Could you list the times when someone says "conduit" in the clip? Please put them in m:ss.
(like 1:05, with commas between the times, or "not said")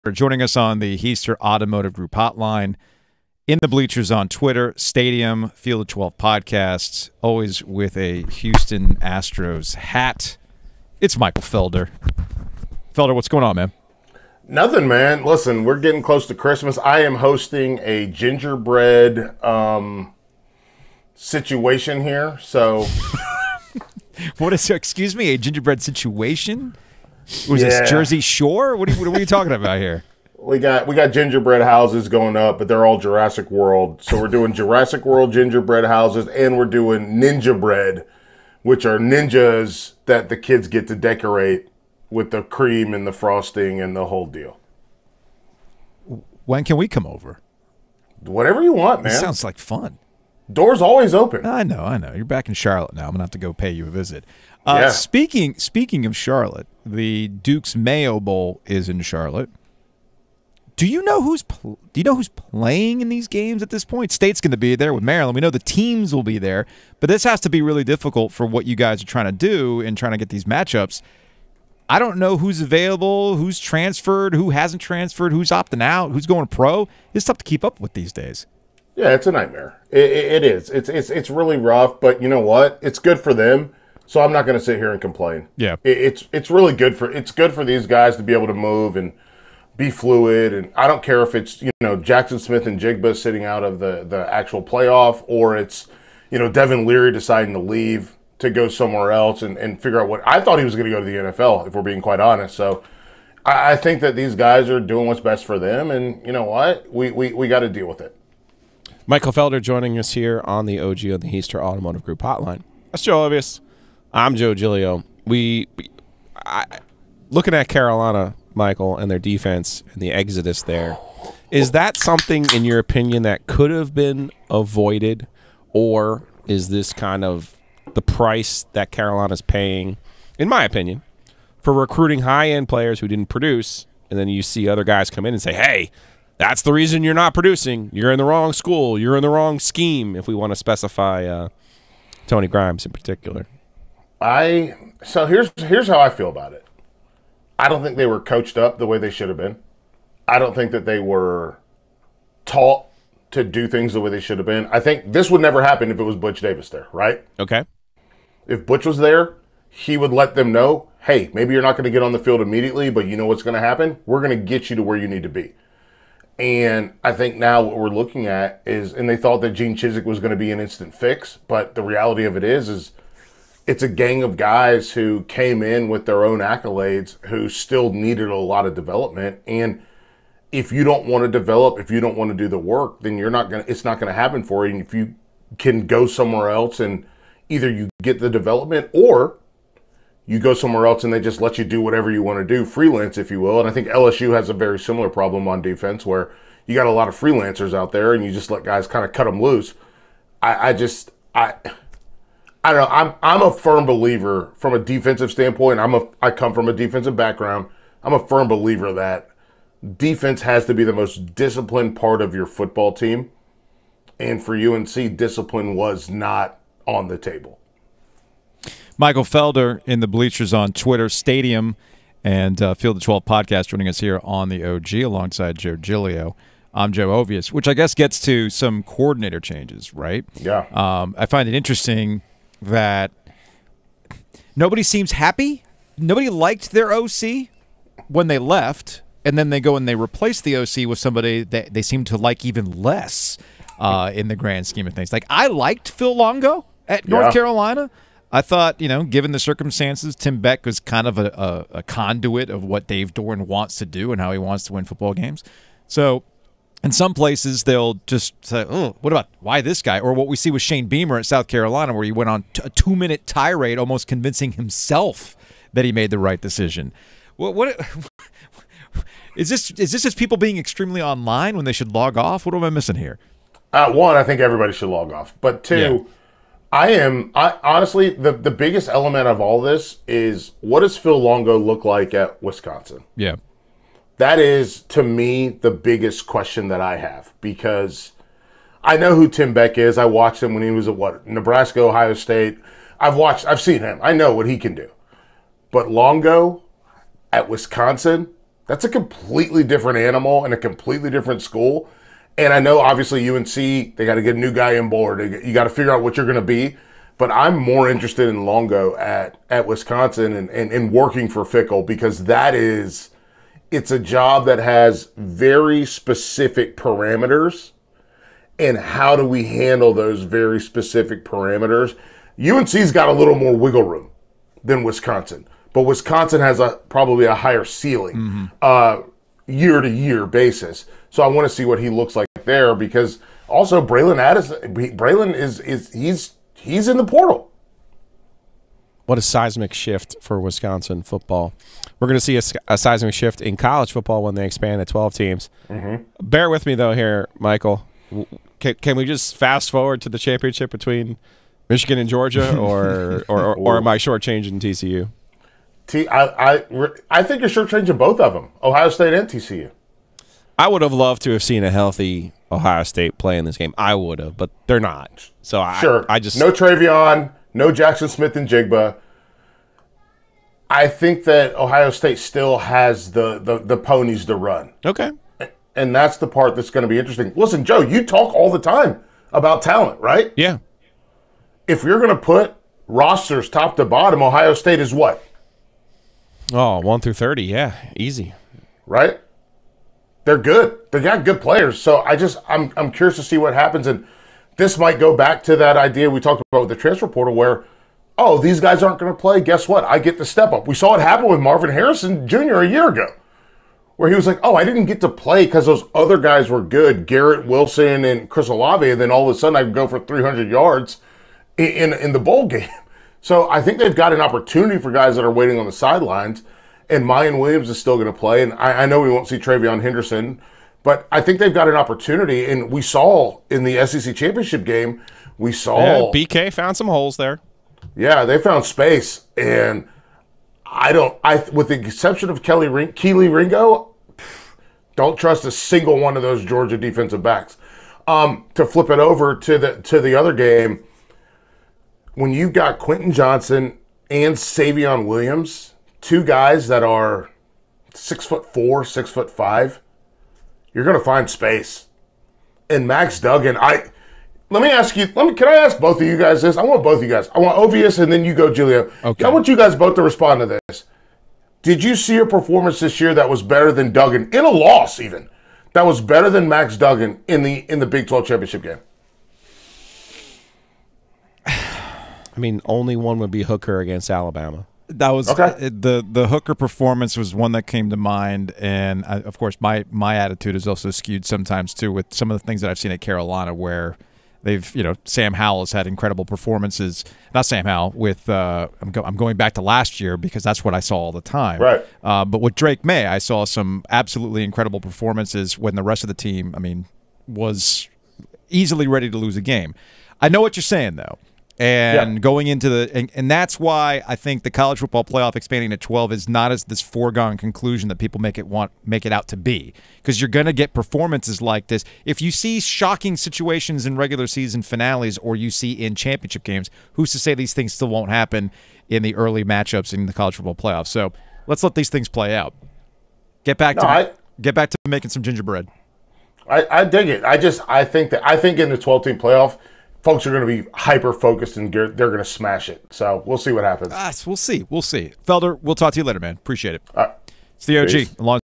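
4:11.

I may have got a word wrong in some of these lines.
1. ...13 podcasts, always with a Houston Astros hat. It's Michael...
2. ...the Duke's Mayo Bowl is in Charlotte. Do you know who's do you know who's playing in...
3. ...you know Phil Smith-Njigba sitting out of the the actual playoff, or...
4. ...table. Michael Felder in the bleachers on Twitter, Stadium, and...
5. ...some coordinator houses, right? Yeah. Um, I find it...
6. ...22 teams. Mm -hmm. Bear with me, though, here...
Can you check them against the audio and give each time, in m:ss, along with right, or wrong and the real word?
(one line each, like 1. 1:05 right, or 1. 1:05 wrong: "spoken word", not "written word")
1. 0:05 wrong: "12", not "13"
2. 0:56 right
3. 1:31 wrong: "Jaxon", not "Phil"
4. 3:37 right
5. 3:48 wrong: "changes", not "houses"
6. 5:44 wrong: "12", not "22".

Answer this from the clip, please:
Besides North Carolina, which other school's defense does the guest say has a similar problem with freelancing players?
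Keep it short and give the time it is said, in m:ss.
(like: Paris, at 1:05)
LSU, at 3:13.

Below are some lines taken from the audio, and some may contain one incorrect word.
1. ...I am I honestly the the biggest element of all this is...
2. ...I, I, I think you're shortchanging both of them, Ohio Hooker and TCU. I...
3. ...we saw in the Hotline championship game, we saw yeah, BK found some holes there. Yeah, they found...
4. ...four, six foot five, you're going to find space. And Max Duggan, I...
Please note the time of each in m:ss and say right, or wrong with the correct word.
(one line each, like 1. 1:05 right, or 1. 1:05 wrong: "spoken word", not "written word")
1. 4:36 right
2. 5:55 wrong: "State", not "Hooker"
3. 7:02 wrong: "SEC", not "Hotline"
4. 7:28 right.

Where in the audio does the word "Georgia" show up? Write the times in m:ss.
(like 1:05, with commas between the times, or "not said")
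5:52, 7:16.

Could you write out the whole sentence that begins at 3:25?
I'm a I come from a defensive background.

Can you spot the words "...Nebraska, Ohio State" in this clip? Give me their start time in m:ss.
4:51.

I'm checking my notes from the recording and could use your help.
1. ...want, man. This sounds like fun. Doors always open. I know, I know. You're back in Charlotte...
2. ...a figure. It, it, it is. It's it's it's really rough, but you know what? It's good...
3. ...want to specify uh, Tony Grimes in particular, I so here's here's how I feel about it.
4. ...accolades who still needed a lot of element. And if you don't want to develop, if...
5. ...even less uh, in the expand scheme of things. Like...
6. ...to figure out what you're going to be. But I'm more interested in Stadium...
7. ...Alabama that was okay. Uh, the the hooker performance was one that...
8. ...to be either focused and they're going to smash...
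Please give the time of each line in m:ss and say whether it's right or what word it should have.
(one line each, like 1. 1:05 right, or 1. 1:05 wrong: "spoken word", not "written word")
1. 0:48 right
2. 1:19 wrong: "nightmare", not "figure"
3. 2:20 right
4. 2:56 wrong: "development", not "element"
5. 4:02 wrong: "grand", not "expand"
6. 5:05 wrong: "Longo", not "Stadium"
7. 7:54 right
8. 8:50 wrong: "hyper", not "either".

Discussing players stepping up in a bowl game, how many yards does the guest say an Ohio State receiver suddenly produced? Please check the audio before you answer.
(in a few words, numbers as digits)
300.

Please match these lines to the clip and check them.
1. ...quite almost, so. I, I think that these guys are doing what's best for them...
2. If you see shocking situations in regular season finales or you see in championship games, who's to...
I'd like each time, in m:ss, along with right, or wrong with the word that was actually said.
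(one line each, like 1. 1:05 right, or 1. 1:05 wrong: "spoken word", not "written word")
1. 1:42 wrong: "honest", not "almost"
2. 8:32 right.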